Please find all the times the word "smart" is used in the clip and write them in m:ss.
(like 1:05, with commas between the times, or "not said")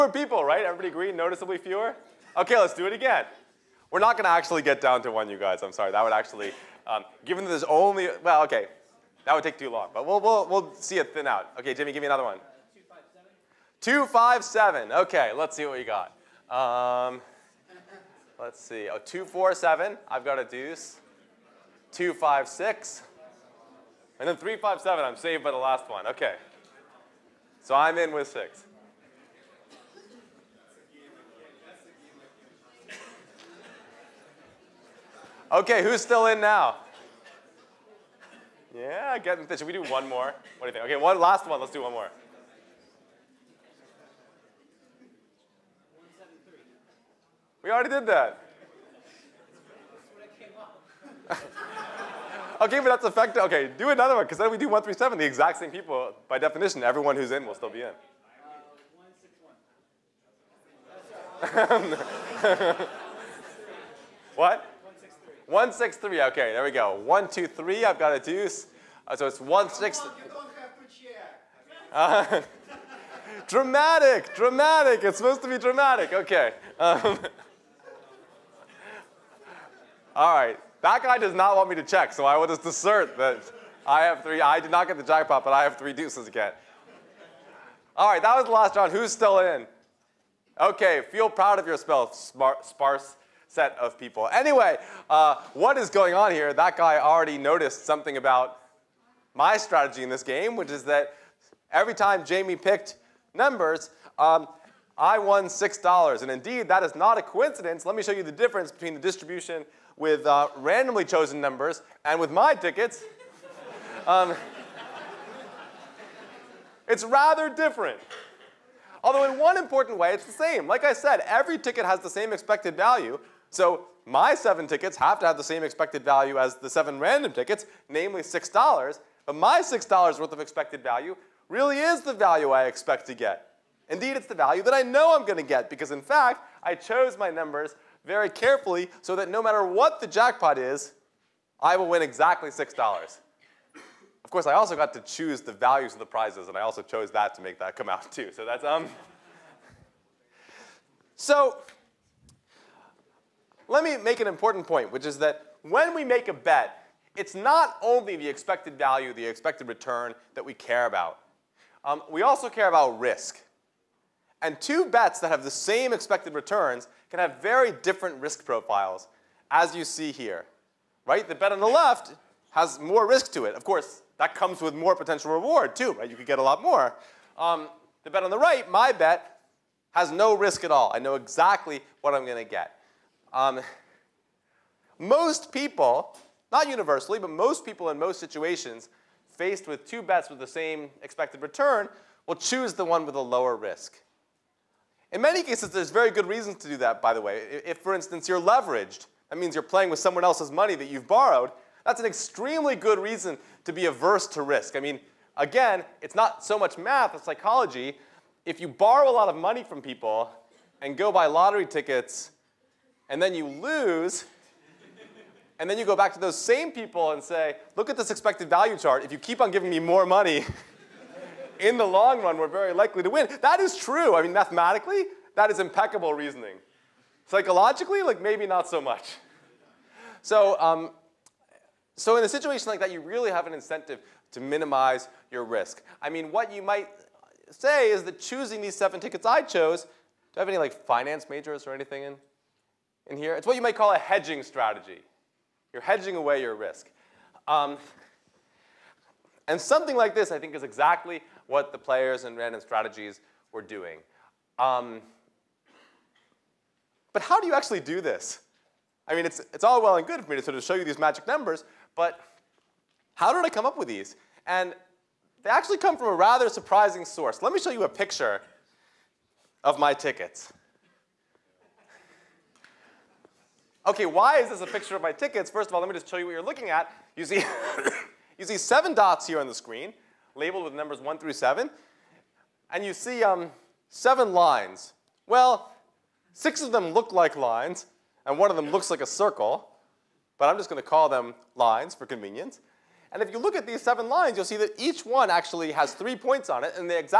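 1:31.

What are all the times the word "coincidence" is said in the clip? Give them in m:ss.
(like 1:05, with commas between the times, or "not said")
1:47.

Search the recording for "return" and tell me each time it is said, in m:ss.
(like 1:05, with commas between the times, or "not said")
2:39, 2:46, 3:11.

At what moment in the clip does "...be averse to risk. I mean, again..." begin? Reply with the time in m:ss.
3:23.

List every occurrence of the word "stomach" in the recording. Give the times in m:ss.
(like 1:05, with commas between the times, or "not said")
not said.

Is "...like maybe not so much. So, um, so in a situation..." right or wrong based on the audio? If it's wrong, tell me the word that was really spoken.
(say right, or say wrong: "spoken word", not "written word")
right.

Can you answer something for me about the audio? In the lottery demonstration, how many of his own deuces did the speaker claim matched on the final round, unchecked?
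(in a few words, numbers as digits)
3.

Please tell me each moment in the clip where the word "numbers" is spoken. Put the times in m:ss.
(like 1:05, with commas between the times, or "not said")
1:43, 1:51, 2:17, 4:21, 4:40.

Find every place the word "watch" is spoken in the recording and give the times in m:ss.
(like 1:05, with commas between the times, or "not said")
not said.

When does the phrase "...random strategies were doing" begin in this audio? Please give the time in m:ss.
4:12.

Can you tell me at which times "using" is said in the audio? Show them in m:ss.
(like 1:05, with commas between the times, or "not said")
not said.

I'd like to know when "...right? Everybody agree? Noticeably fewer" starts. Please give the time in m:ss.
0:00.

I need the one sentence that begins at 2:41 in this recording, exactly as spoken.
Um, we also care about risk.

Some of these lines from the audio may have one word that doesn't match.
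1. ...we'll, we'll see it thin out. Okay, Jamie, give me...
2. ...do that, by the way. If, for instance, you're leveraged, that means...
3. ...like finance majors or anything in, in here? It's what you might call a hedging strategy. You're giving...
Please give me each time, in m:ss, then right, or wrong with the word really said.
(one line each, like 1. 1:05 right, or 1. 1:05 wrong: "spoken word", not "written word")
1. 0:10 wrong: "Jimmy", not "Jamie"
2. 3:16 right
3. 4:00 wrong: "hedging", not "giving".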